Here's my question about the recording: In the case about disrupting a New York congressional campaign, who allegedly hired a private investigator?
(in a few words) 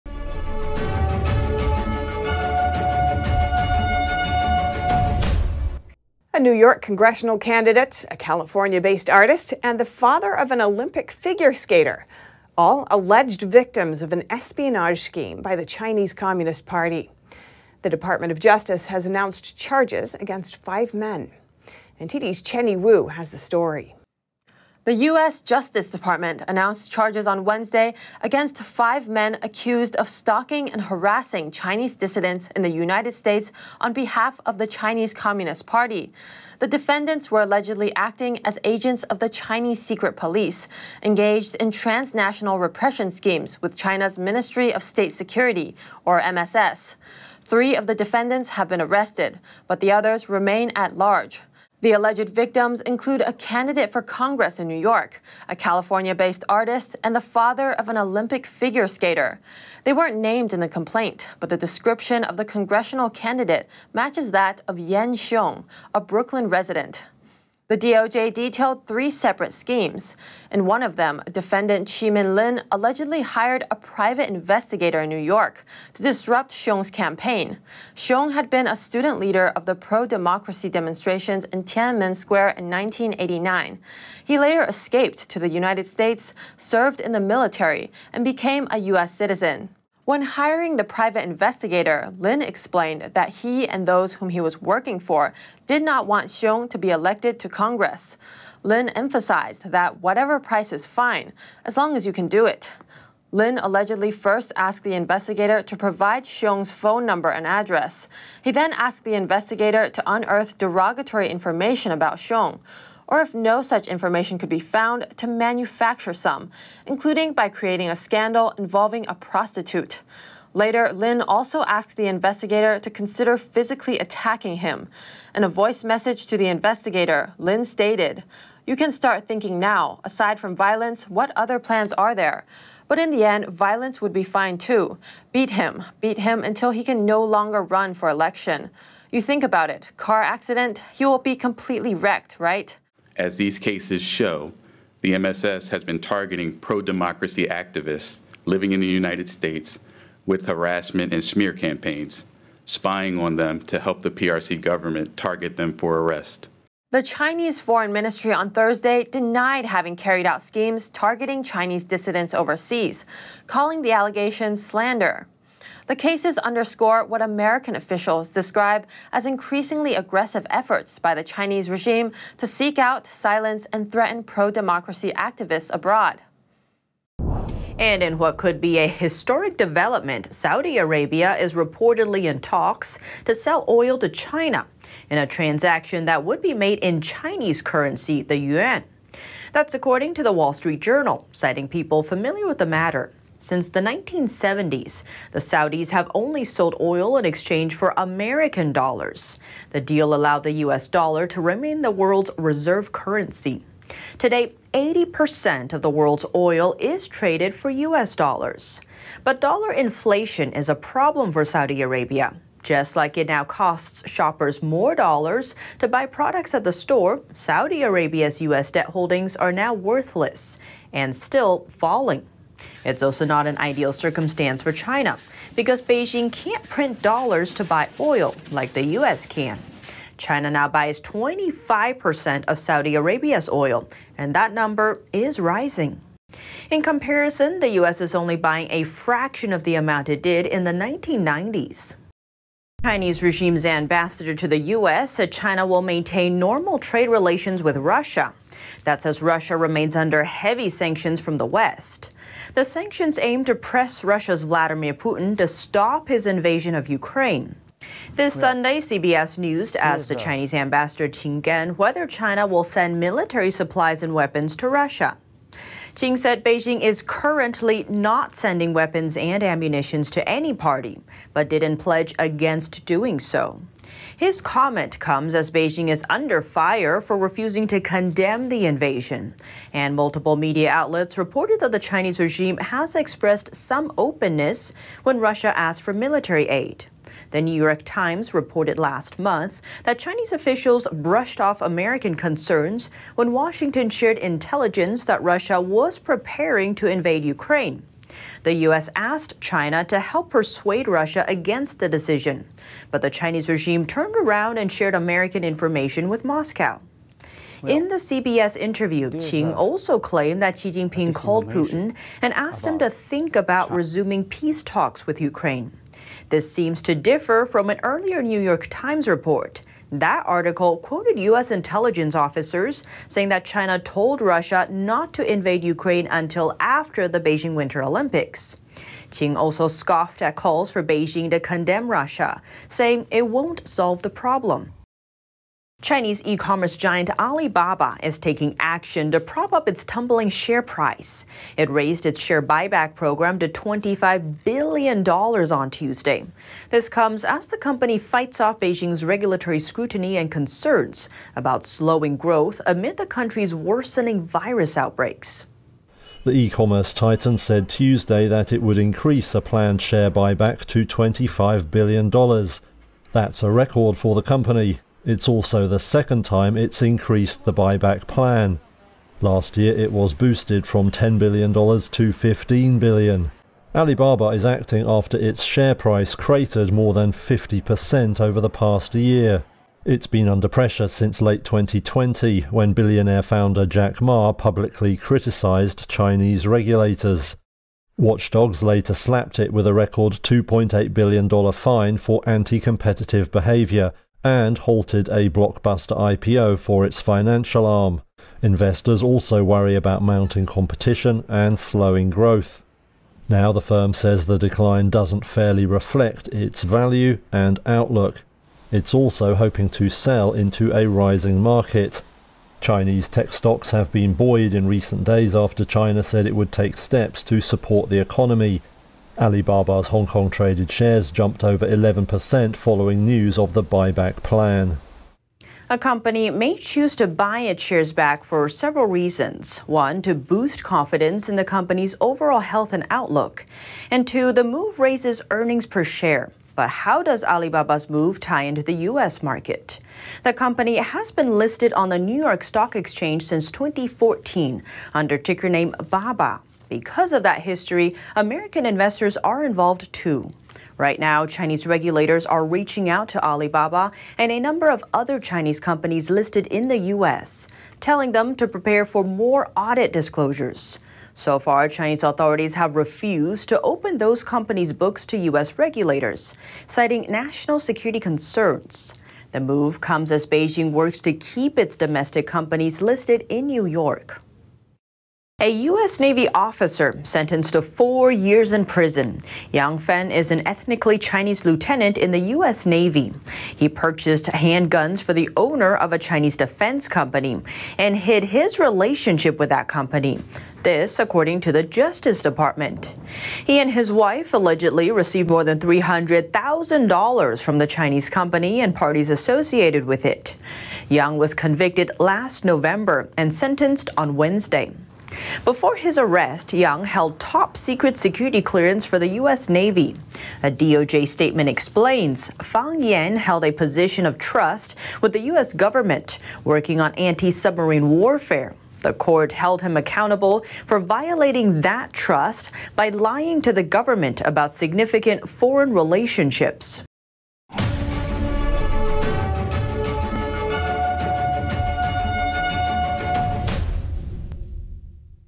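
Chi Min Lin.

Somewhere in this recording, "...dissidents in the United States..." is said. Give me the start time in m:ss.
0:31.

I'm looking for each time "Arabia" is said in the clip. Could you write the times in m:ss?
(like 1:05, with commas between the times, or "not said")
3:00, 3:31, 3:37, 3:52.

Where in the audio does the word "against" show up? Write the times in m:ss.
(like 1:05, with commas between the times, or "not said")
0:20, 0:28, 4:32, 5:01.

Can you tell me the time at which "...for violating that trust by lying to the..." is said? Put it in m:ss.
8:40.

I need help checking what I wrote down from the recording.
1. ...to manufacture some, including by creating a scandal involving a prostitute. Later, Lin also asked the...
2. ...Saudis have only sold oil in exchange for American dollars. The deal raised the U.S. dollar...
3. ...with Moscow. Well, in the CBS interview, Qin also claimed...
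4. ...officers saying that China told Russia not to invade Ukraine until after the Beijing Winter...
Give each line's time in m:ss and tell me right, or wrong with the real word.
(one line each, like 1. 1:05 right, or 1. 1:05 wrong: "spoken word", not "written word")
1. 1:55 right
2. 3:15 wrong: "allowed", not "raised"
3. 5:06 right
4. 5:22 right.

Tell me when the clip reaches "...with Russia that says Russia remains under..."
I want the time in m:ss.
4:07.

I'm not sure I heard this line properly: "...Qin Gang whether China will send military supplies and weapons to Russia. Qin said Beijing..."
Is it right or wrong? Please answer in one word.
right.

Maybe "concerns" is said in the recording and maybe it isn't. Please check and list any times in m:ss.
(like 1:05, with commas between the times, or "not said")
4:52, 5:50, 7:47.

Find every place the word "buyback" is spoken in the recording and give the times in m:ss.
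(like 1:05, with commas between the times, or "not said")
5:42, 6:00, 6:07, 7:03.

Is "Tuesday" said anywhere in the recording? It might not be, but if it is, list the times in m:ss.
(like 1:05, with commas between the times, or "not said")
5:45, 5:57.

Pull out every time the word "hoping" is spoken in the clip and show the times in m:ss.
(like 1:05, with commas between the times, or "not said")
6:49.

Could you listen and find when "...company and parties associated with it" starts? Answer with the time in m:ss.
8:18.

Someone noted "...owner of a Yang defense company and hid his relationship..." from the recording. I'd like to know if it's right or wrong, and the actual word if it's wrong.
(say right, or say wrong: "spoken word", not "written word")
wrong: "Chinese", not "Yang".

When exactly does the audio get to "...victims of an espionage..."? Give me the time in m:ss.
0:13.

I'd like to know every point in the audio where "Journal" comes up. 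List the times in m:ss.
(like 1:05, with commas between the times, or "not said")
3:10.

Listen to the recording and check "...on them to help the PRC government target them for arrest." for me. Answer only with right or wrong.
right.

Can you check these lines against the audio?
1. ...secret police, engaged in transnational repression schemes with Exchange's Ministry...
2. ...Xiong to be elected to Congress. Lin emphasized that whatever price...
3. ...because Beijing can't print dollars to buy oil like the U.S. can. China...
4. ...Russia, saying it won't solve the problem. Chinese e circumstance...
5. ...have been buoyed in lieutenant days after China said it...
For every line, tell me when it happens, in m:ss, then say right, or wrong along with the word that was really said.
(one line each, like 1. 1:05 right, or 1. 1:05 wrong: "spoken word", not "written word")
1. 0:39 wrong: "China", not "Exchange"
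2. 1:36 right
3. 3:45 right
4. 5:31 wrong: "commerce", not "circumstance"
5. 6:53 wrong: "recent", not "lieutenant".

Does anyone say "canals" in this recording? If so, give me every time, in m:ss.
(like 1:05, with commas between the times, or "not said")
not said.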